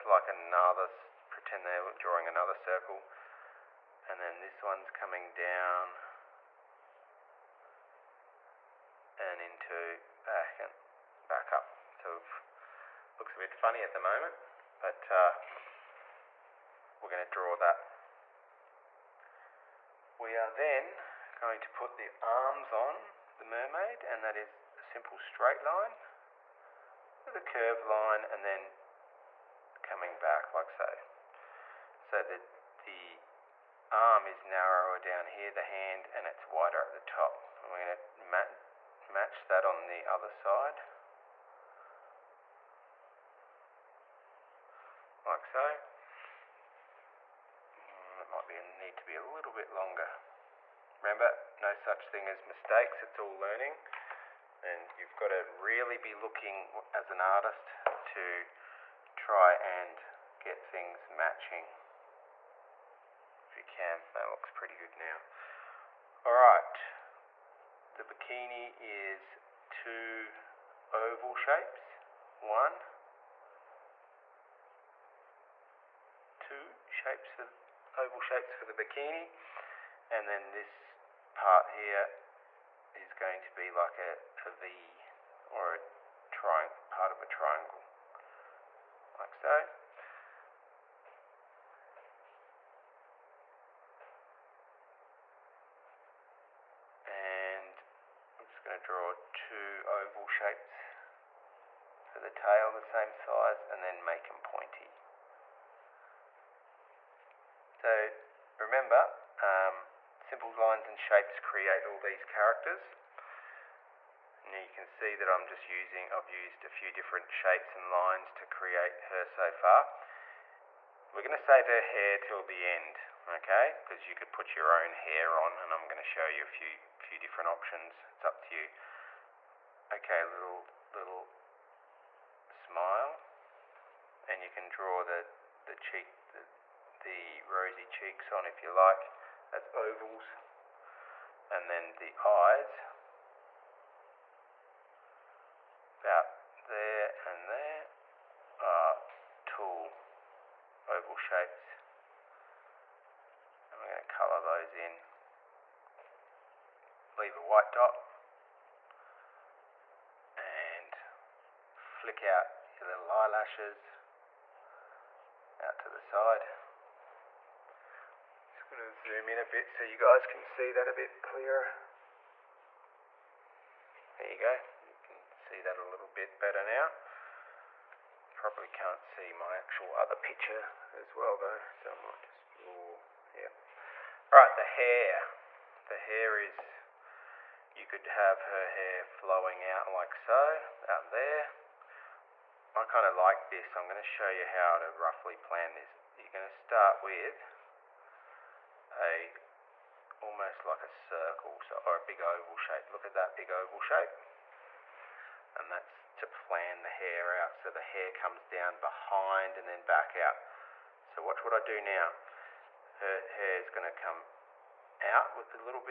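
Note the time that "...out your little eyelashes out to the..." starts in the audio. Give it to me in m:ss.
2:42.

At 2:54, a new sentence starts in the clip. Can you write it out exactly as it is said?
There you go, you can see that a little bit better now.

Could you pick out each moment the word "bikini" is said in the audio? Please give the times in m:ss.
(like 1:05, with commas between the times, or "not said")
1:08, 1:18.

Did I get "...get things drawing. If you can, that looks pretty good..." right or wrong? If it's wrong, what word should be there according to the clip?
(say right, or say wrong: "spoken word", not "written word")
wrong: "matching", not "drawing".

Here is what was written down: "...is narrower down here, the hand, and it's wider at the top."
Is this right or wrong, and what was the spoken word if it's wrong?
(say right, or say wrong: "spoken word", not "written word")
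right.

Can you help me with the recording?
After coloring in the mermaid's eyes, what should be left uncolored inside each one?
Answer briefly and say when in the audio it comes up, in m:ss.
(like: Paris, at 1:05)
A white dot, at 2:37.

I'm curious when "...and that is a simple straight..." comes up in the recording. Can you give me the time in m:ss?
0:24.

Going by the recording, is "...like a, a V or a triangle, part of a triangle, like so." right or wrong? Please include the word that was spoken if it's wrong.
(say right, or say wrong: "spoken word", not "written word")
right.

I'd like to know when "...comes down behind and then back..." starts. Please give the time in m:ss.
3:28.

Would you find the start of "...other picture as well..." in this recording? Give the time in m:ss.
2:59.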